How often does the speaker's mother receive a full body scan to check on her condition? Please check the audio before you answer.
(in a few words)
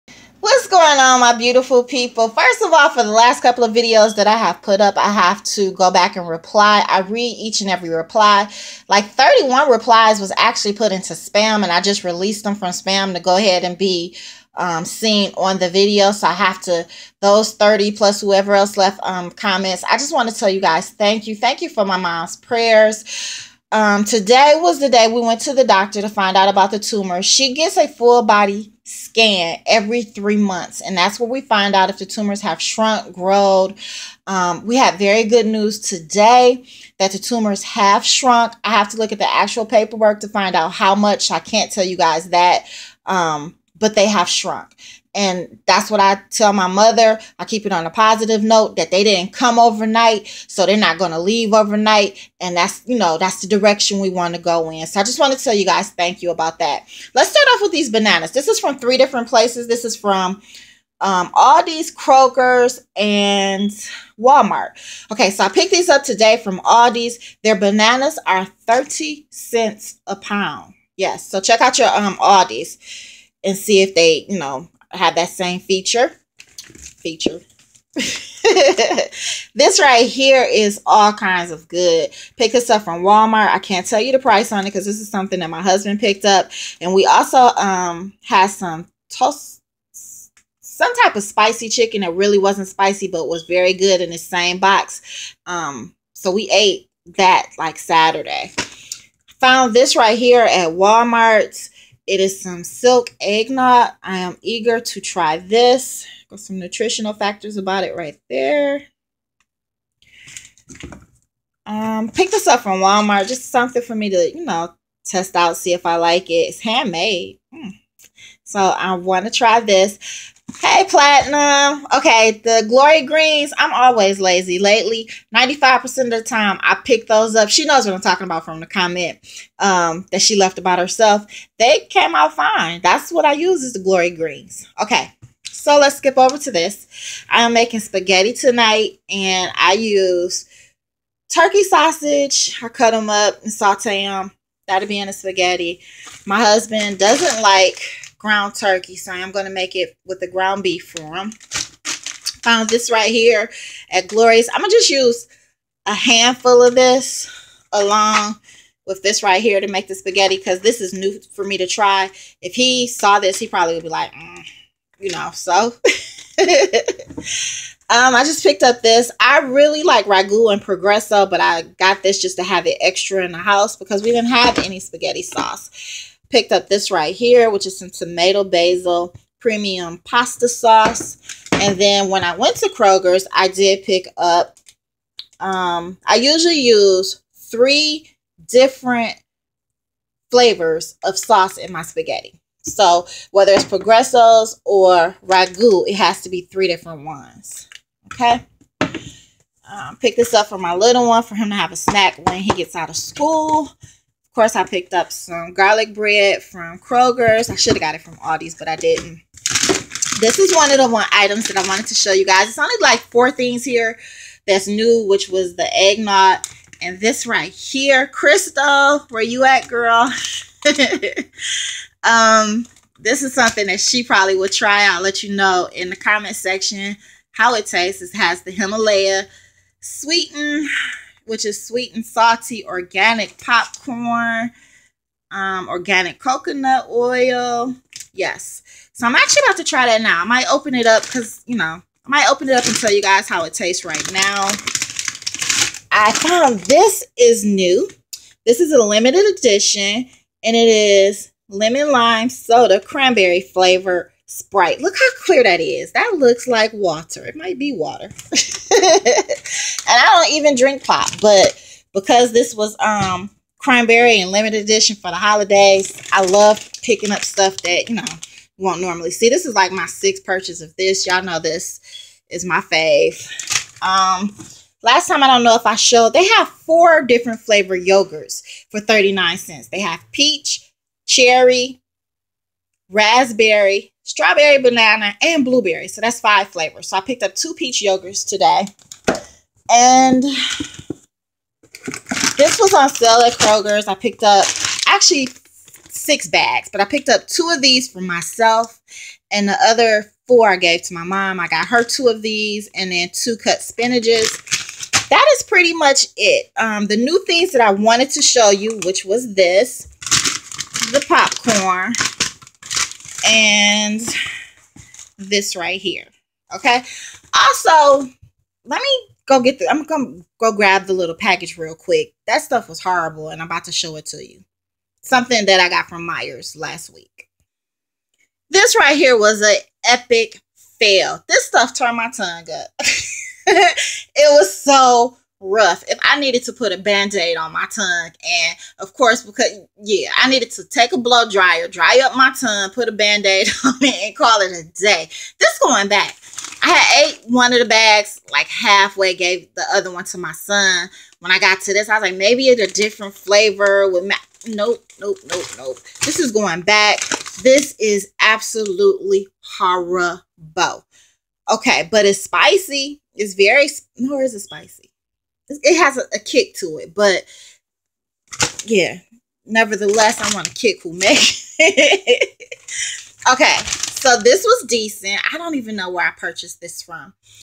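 every 3 months.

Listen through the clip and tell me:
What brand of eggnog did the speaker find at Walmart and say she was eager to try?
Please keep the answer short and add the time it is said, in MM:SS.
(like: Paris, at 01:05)
Silk, at 01:42.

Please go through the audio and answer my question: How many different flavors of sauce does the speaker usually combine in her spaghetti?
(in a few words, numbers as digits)
3.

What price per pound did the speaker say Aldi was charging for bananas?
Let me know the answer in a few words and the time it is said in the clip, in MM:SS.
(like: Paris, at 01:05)
30 cents, at 01:08.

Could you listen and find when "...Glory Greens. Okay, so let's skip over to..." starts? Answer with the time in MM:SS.
02:13.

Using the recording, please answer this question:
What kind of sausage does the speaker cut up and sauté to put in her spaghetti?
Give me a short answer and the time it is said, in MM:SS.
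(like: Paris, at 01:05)
turkey sausage, at 02:21.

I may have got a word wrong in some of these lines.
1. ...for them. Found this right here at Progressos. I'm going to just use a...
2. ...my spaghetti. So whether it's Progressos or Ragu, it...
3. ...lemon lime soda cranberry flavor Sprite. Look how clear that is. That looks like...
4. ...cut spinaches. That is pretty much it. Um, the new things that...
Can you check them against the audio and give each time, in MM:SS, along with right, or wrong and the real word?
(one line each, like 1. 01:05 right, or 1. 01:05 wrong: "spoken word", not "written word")
1. 02:30 wrong: "Glorious", not "Progressos"
2. 03:11 right
3. 04:11 right
4. 05:03 right.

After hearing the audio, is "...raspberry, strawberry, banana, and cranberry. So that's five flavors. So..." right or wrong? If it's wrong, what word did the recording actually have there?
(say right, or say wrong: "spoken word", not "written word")
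wrong: "blueberry", not "cranberry".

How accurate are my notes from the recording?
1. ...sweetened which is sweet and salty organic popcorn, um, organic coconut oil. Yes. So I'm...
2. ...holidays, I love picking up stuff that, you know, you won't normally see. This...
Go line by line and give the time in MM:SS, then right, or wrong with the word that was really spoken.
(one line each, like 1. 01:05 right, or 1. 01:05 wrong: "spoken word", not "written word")
1. 03:49 right
2. 04:25 right.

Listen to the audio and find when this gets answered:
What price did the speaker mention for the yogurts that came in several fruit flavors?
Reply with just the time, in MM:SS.
04:38.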